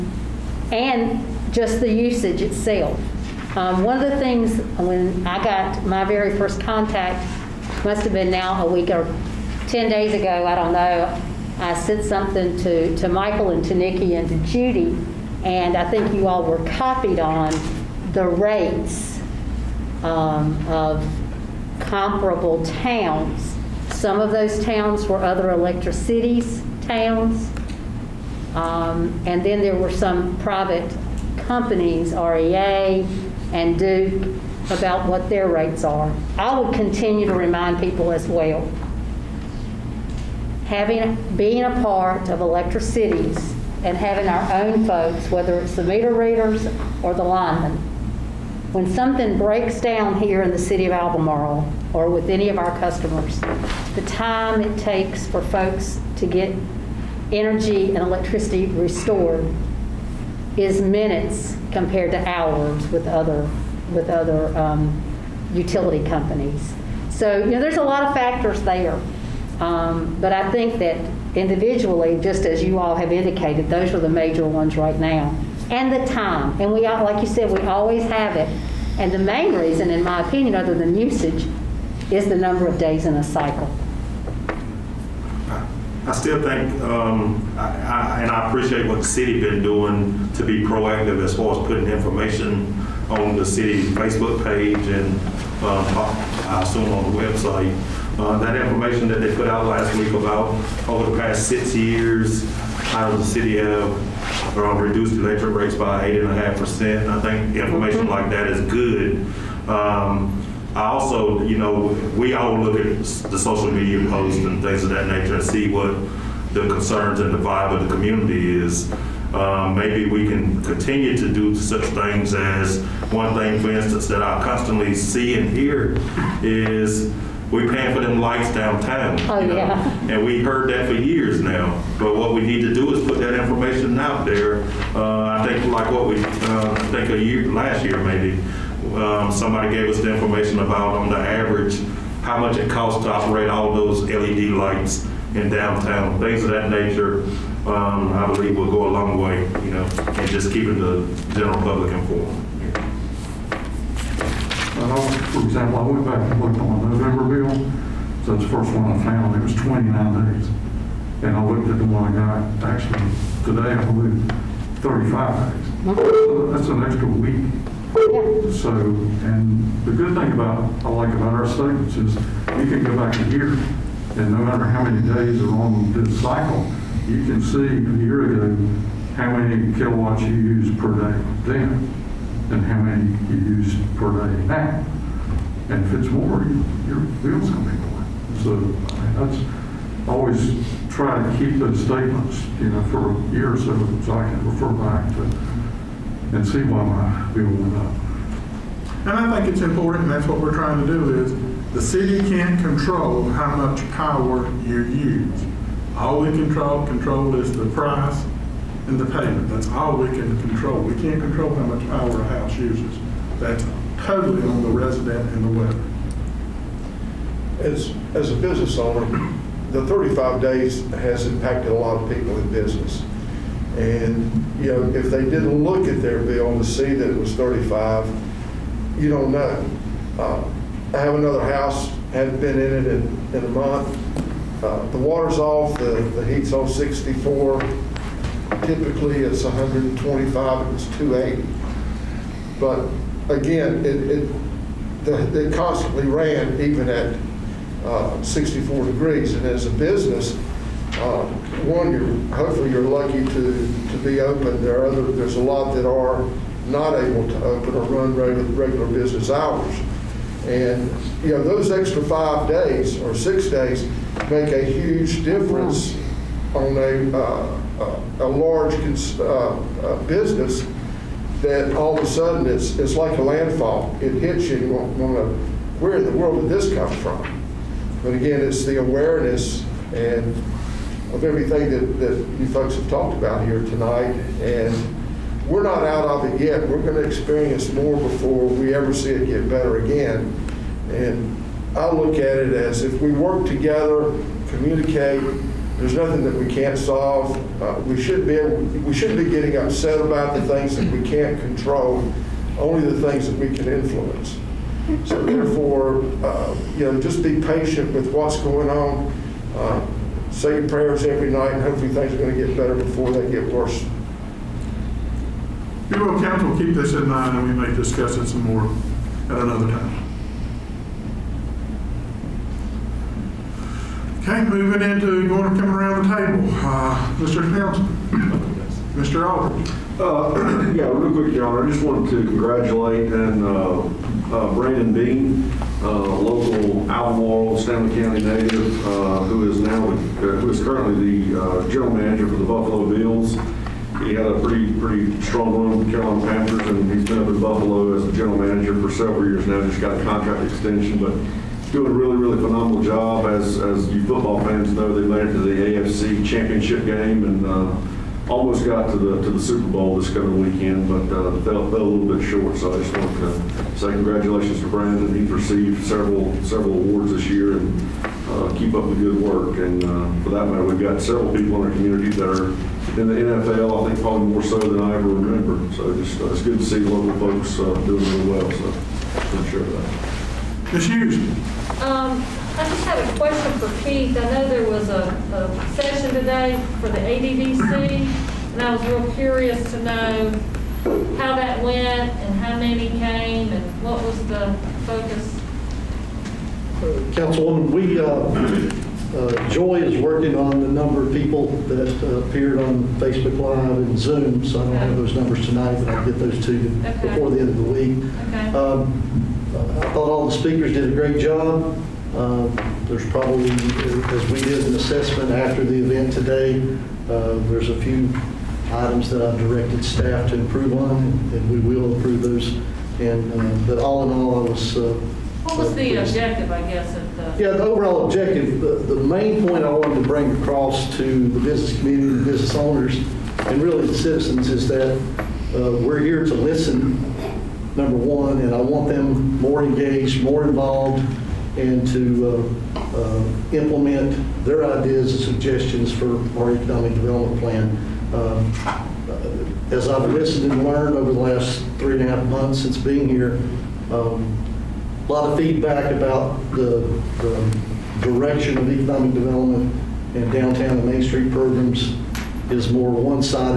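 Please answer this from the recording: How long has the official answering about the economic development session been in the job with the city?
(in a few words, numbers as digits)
3.5 months.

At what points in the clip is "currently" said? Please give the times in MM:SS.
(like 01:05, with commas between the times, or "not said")
05:40.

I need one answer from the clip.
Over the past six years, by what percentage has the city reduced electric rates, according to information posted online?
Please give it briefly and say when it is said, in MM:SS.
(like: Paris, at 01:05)
8.5%, at 01:46.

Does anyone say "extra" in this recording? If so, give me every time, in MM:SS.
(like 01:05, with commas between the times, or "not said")
02:46, 04:21.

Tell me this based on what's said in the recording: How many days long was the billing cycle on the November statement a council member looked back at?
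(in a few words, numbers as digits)
29.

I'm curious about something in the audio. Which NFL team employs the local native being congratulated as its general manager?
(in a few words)
Buffalo Bills.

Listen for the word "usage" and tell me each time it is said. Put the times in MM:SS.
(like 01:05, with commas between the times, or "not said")
00:01, 01:20.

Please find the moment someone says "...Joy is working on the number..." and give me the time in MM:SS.
06:39.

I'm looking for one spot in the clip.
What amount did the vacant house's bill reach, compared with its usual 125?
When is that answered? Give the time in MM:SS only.
04:00.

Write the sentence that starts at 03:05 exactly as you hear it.
And if it's more, you, your bill's going to be more.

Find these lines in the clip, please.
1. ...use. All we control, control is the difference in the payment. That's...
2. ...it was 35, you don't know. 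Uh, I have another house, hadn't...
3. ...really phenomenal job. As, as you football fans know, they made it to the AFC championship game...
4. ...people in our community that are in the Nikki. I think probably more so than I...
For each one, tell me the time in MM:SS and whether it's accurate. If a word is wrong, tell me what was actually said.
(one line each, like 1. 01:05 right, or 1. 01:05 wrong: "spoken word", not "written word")
1. 03:24 wrong: "price", not "difference"
2. 03:47 right
3. 05:52 right
4. 06:11 wrong: "NFL", not "Nikki".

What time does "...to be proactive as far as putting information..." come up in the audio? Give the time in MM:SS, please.
01:30.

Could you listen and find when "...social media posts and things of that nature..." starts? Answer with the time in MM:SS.
01:53.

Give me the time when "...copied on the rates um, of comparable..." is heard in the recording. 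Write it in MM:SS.
00:16.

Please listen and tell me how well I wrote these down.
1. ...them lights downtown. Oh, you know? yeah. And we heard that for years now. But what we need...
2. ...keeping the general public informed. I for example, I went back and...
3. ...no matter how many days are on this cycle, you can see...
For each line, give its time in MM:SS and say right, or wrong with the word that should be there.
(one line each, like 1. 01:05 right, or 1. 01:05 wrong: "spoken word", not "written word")
1. 02:08 right
2. 02:30 right
3. 02:54 right.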